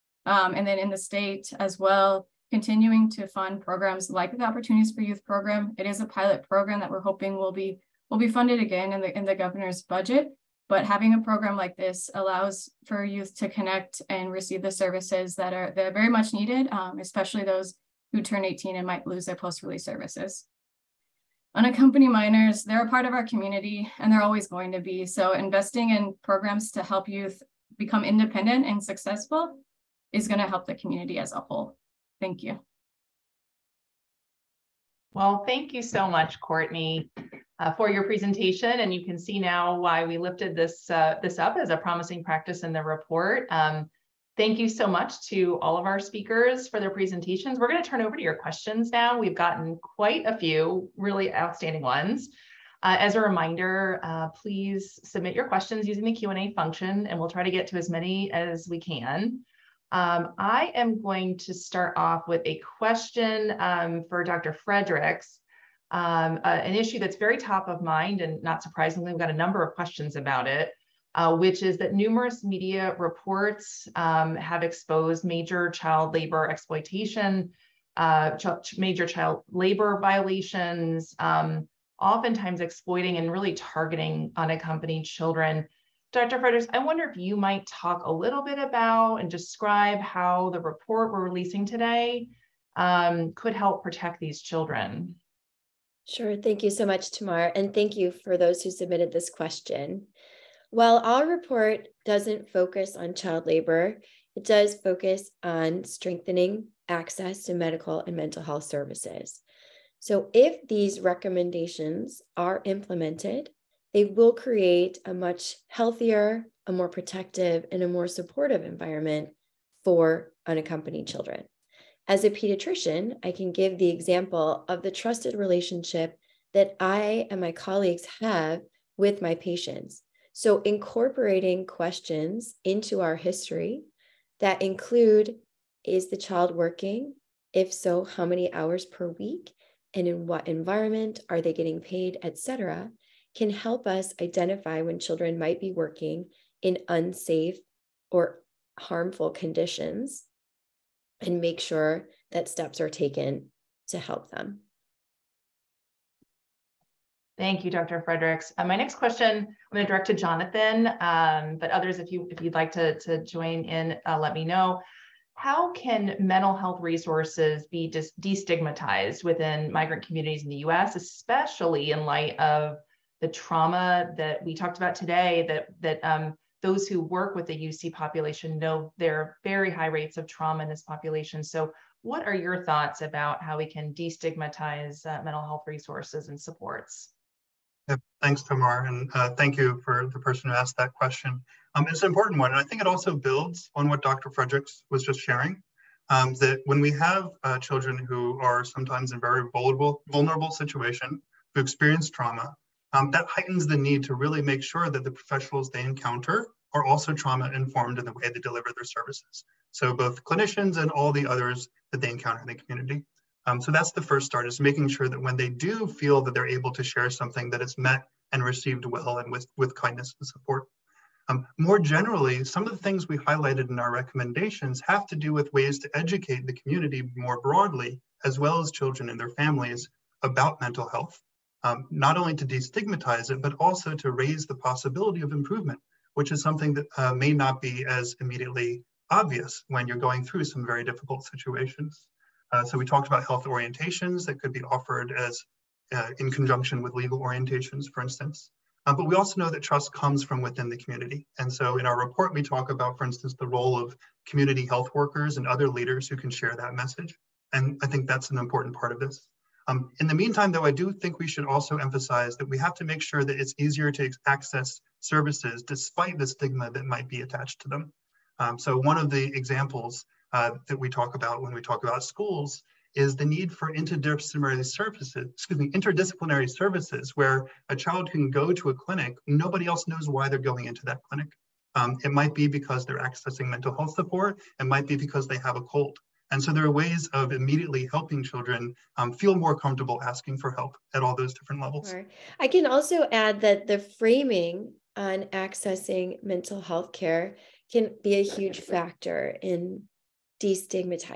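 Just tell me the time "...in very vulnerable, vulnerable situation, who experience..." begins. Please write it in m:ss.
3:19.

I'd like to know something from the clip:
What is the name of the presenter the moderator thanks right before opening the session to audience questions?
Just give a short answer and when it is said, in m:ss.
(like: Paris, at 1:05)
Courtney, at 0:36.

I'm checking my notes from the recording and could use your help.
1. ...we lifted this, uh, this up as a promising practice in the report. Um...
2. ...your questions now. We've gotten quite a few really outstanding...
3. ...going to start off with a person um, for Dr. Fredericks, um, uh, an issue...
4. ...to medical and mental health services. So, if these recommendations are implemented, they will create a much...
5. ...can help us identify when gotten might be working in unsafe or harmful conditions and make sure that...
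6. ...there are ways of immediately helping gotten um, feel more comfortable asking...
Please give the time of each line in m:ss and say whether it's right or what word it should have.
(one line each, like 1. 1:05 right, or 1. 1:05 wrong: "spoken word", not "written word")
1. 0:40 right
2. 0:48 right
3. 1:01 wrong: "question", not "person"
4. 1:47 right
5. 2:23 wrong: "children", not "gotten"
6. 4:46 wrong: "children", not "gotten".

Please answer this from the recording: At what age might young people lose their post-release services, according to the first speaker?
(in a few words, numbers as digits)
18.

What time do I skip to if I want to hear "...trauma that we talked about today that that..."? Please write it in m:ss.
2:53.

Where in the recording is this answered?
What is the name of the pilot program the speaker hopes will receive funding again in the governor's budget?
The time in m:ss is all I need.
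0:04.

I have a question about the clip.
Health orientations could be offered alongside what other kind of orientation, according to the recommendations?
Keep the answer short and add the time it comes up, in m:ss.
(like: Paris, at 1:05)
legal orientations, at 4:06.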